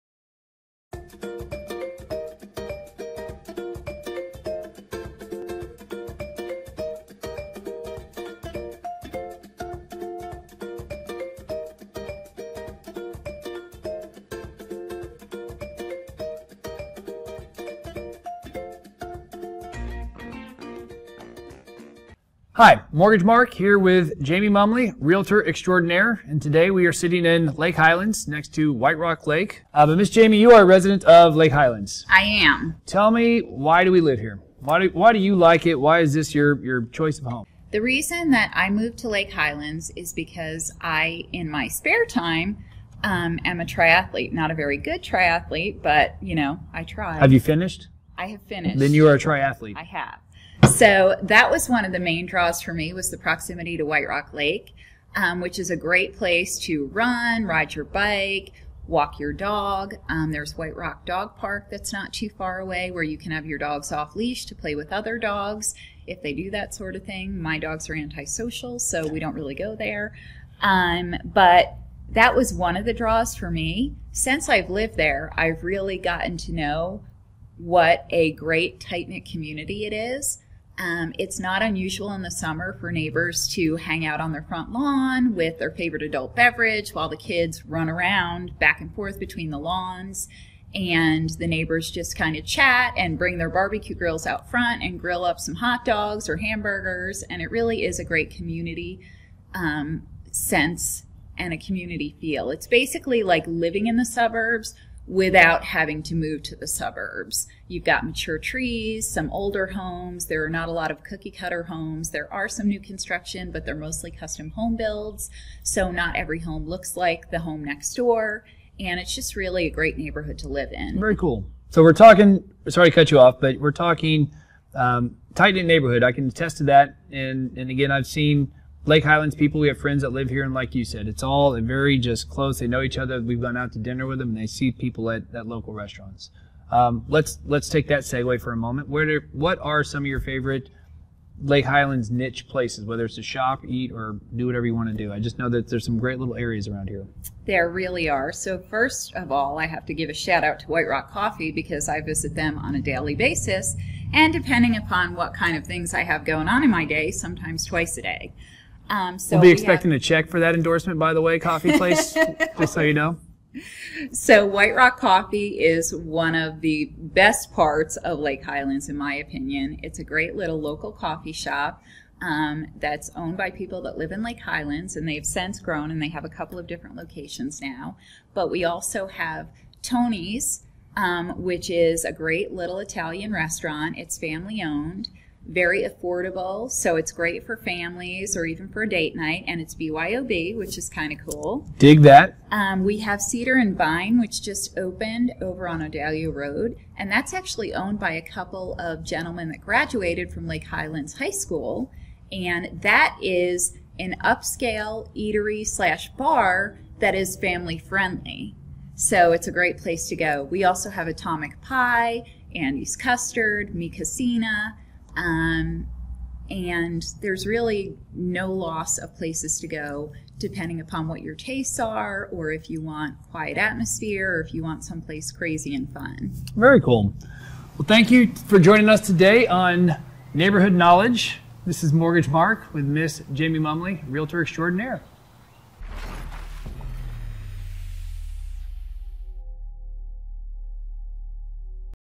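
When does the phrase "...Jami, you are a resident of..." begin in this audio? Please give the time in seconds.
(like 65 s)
30 s.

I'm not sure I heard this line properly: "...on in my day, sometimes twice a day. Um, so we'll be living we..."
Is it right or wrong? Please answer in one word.
wrong.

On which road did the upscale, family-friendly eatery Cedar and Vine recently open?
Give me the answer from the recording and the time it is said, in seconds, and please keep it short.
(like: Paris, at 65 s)
Audelia Road, at 195 s.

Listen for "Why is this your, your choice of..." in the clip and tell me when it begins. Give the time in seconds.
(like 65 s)
35 s.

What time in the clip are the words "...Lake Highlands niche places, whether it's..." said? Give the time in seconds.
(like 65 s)
141 s.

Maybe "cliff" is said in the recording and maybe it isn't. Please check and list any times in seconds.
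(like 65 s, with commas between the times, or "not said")
not said.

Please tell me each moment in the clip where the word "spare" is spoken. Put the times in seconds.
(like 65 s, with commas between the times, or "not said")
41 s.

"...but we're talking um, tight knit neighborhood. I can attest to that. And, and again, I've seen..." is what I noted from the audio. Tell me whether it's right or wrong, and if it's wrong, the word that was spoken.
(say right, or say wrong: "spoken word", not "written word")
right.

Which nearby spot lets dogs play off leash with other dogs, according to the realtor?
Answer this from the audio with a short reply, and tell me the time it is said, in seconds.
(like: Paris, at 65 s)
White Rock Dog Park, at 60 s.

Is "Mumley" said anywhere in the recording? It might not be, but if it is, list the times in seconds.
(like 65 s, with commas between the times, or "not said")
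24 s, 233 s.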